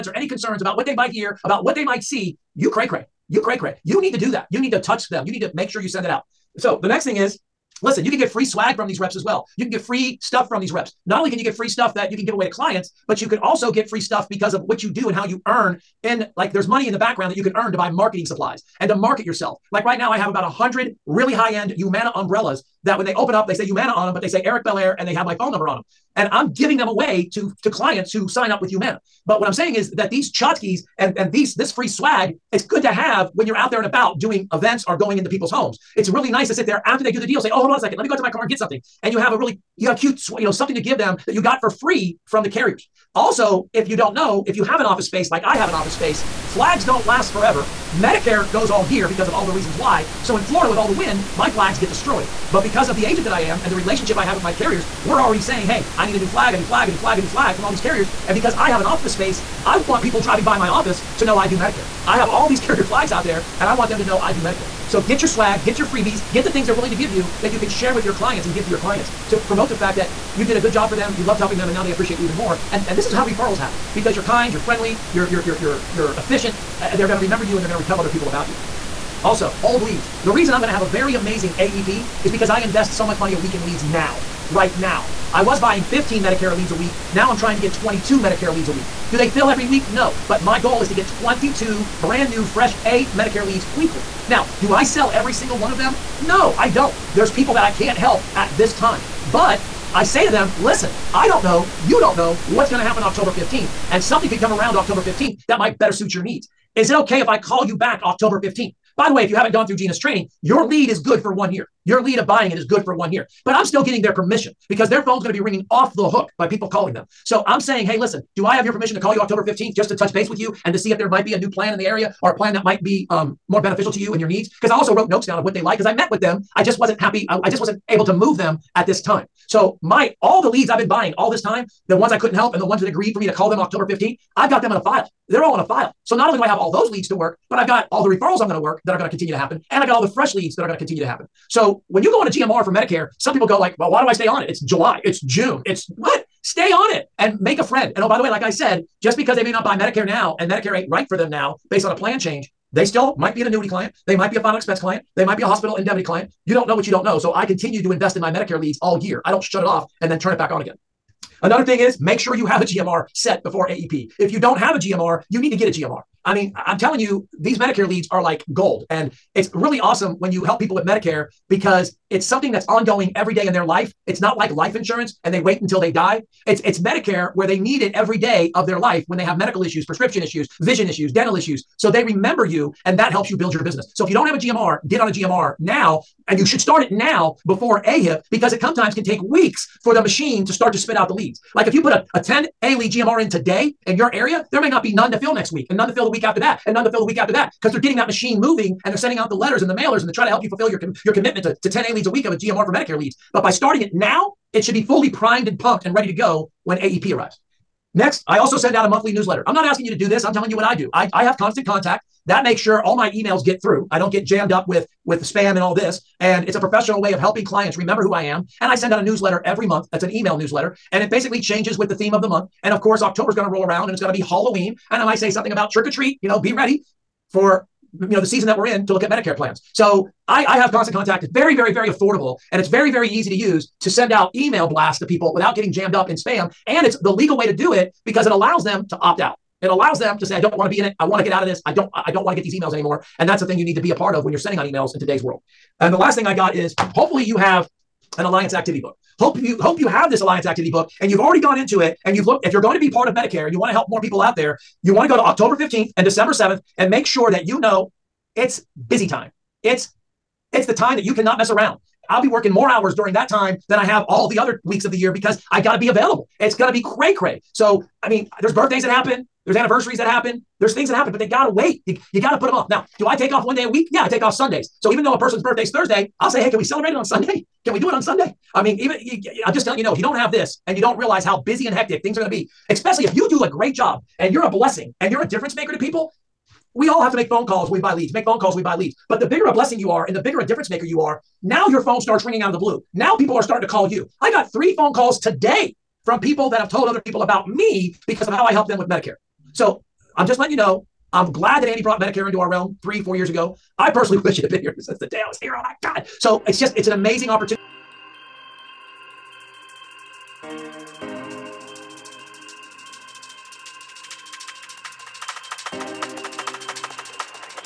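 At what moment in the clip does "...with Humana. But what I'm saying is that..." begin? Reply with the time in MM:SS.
00:28.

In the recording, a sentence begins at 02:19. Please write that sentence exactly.
And I got all the fresh leads that are going to continue to happen.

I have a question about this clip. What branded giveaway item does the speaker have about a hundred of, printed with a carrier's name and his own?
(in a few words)
Umbrellas.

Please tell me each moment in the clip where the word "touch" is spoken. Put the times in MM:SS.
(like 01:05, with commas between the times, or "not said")
00:04, 01:59.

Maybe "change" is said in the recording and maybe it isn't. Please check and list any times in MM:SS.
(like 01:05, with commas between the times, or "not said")
02:32, 03:41.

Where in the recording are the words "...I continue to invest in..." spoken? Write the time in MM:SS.
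02:37.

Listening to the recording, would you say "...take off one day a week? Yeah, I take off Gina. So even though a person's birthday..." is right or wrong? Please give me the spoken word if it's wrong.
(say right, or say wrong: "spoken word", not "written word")
wrong: "Sundays", not "Gina".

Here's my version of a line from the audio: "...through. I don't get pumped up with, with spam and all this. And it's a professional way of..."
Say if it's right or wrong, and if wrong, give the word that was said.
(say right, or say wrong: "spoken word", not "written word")
wrong: "jammed", not "pumped".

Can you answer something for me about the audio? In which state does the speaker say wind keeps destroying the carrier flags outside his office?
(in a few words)
Florida.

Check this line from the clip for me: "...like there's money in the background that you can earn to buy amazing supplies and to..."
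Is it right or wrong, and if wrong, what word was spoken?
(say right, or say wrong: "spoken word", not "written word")
wrong: "marketing", not "amazing".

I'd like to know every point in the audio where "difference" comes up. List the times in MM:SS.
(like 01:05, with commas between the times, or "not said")
04:45, 04:50.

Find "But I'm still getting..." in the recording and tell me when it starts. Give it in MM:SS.
01:53.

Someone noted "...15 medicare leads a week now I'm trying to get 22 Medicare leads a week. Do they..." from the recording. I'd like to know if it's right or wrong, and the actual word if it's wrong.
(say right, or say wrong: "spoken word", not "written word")
right.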